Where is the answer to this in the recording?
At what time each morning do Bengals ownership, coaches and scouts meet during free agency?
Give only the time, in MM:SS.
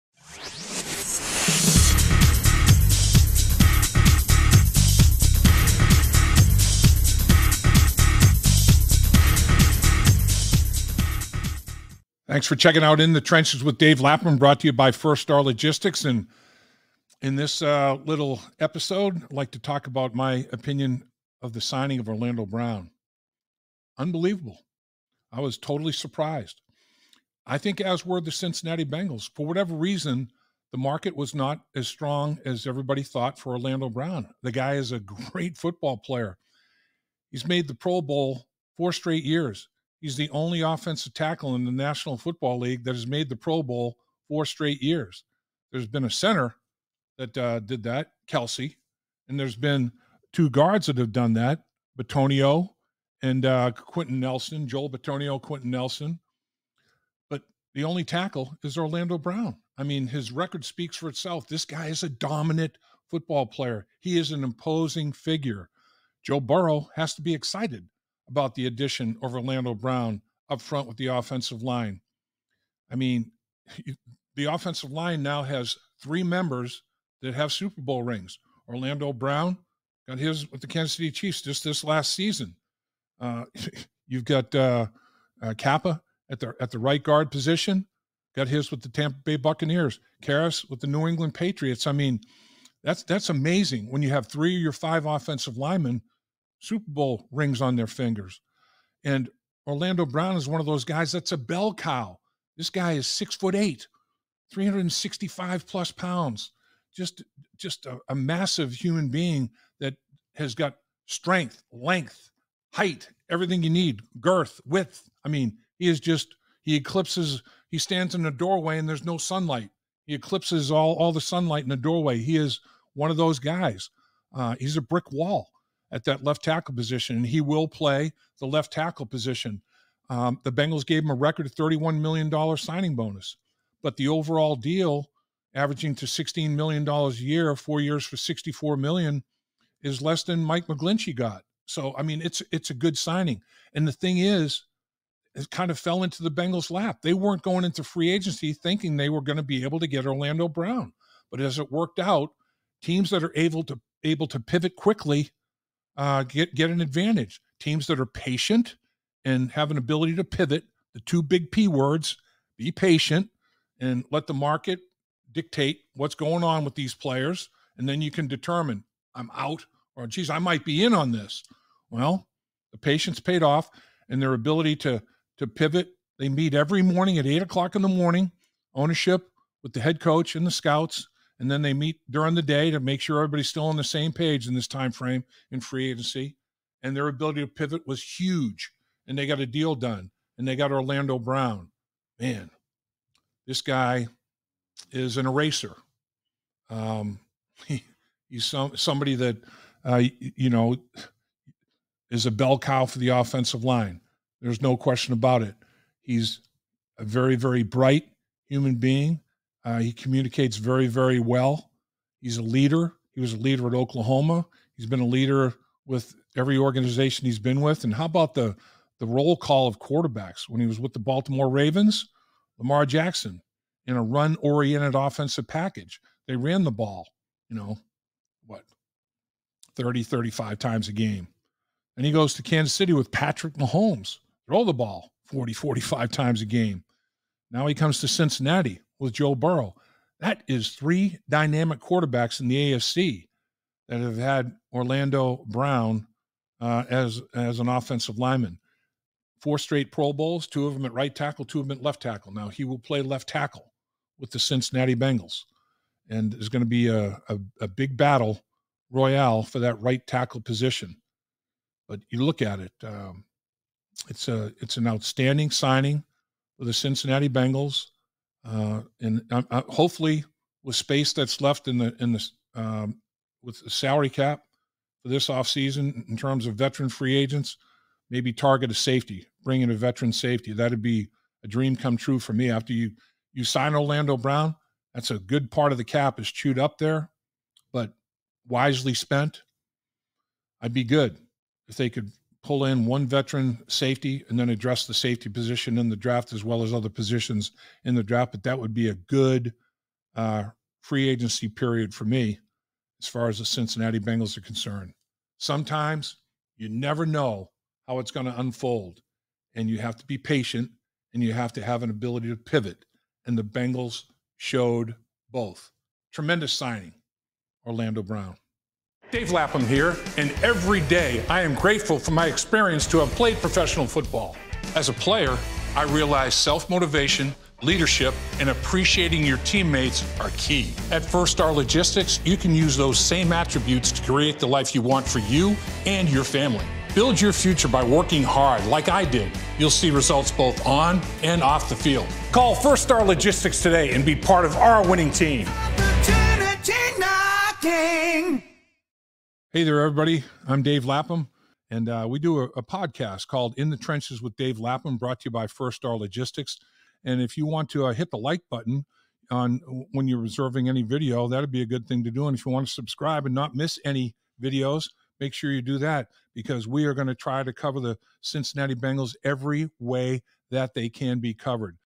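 02:57.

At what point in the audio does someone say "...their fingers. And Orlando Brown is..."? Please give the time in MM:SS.
01:37.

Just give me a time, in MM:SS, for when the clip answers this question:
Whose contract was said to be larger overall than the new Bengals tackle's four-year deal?
02:20.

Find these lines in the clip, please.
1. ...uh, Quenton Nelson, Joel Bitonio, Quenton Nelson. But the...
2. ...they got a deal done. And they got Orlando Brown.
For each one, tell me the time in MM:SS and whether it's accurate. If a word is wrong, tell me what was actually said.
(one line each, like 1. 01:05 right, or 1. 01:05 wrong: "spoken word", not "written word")
1. 00:53 right
2. 03:09 right.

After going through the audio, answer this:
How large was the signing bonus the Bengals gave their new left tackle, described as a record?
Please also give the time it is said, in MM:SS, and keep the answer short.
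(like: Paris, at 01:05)
$31 million, at 02:11.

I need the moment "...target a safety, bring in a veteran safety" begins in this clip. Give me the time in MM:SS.
04:38.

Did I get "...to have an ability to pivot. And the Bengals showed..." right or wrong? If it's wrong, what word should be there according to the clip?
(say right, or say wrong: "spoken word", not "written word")
right.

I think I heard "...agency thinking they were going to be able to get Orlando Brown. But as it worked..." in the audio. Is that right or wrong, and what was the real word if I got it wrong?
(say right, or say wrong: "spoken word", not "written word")
right.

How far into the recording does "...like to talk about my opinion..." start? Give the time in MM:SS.
00:19.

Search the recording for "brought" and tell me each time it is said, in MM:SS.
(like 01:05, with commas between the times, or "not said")
00:14, 05:54.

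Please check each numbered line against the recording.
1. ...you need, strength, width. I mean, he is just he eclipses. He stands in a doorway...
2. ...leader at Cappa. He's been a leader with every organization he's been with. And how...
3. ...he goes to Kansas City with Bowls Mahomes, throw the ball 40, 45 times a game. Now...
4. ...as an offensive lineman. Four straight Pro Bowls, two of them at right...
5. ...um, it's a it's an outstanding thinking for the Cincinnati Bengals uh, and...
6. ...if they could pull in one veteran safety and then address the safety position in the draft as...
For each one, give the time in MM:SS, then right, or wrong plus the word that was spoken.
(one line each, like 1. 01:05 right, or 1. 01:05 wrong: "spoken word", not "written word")
1. 01:53 wrong: "girth", not "strength"
2. 03:33 wrong: "Oklahoma", not "Cappa"
3. 03:52 wrong: "Patrick", not "Bowls"
4. 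04:07 right
5. 04:22 wrong: "signing", not "thinking"
6. 04:51 right.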